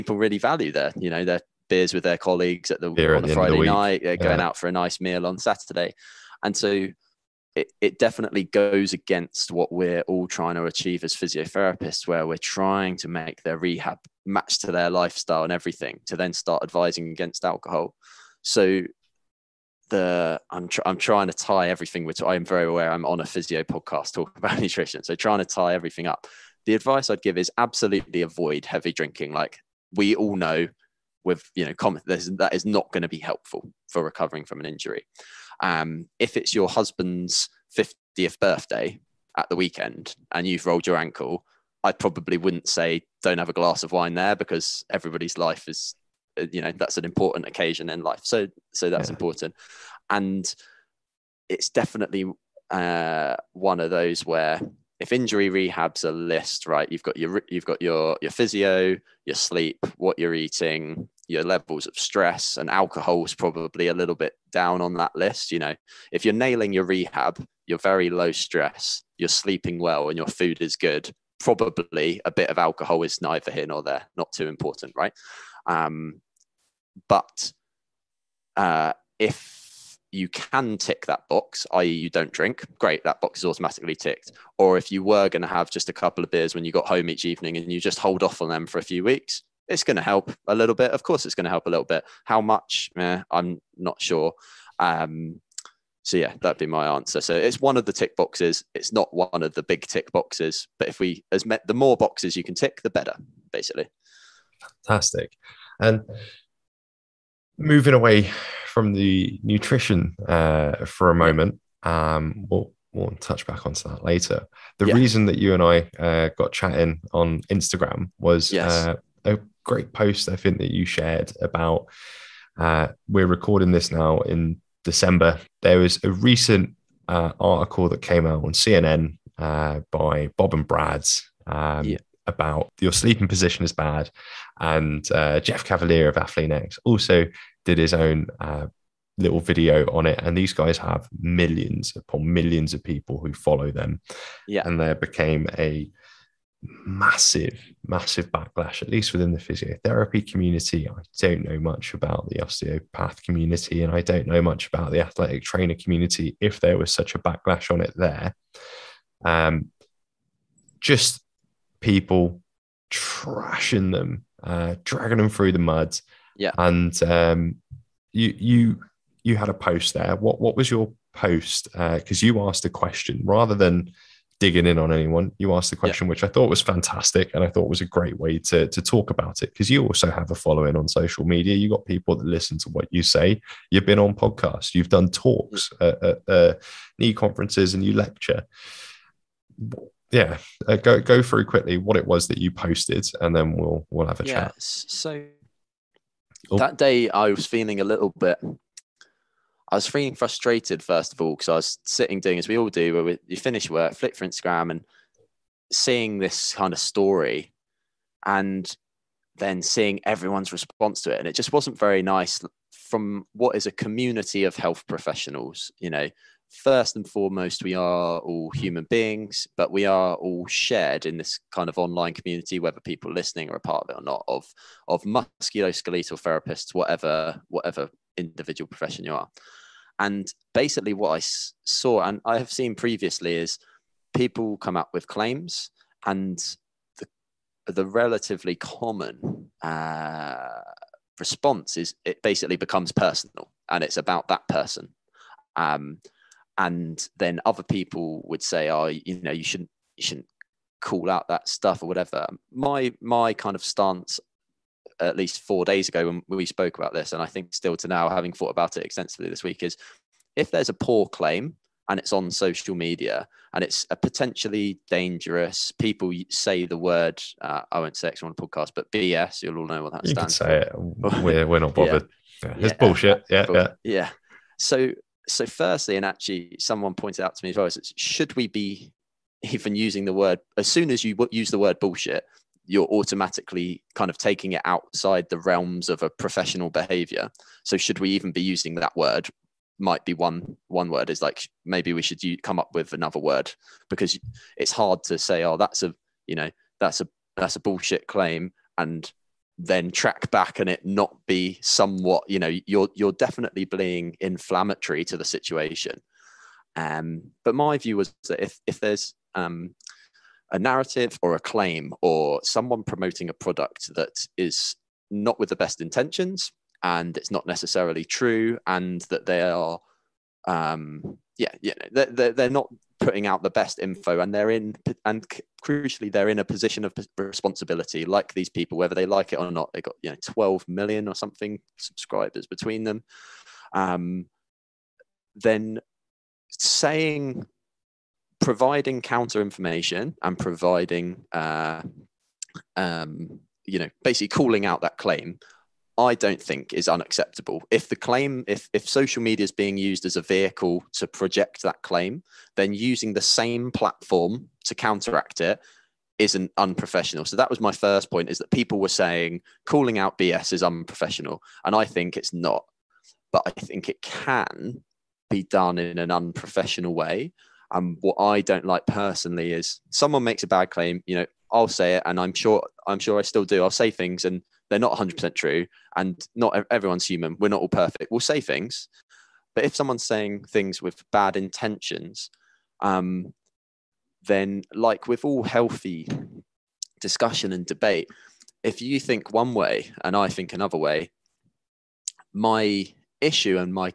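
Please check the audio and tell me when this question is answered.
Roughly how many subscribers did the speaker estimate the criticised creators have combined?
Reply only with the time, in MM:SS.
05:30.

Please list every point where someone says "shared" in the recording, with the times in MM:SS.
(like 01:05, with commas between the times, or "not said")
02:00, 03:40.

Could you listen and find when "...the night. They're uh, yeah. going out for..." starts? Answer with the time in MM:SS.
00:03.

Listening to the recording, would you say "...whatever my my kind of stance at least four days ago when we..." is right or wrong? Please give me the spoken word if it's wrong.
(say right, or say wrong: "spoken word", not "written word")
right.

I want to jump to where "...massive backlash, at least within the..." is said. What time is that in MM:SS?
02:27.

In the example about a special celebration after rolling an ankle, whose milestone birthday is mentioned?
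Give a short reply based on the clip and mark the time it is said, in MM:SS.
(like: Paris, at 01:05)
Husband's 50th, at 00:36.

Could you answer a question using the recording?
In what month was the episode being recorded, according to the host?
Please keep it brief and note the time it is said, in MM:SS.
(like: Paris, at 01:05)
December, at 02:04.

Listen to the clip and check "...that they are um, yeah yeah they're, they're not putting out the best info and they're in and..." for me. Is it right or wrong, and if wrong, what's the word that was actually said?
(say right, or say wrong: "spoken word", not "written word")
right.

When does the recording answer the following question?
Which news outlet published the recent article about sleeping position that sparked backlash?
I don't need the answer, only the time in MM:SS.
02:08.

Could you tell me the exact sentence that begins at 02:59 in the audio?
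Because you also have a following on social media.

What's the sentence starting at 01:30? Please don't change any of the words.
Of course, it's going to help a little bit.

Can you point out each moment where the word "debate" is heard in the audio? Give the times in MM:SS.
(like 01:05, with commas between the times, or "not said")
06:27.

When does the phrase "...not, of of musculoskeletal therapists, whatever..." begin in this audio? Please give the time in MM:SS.
03:44.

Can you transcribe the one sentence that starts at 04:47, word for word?
So should we even be using that word?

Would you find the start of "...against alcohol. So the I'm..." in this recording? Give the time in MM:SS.
00:17.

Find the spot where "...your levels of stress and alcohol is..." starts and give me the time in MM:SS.
01:01.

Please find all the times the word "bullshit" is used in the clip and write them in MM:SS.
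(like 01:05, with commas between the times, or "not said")
04:32, 04:41, 04:57.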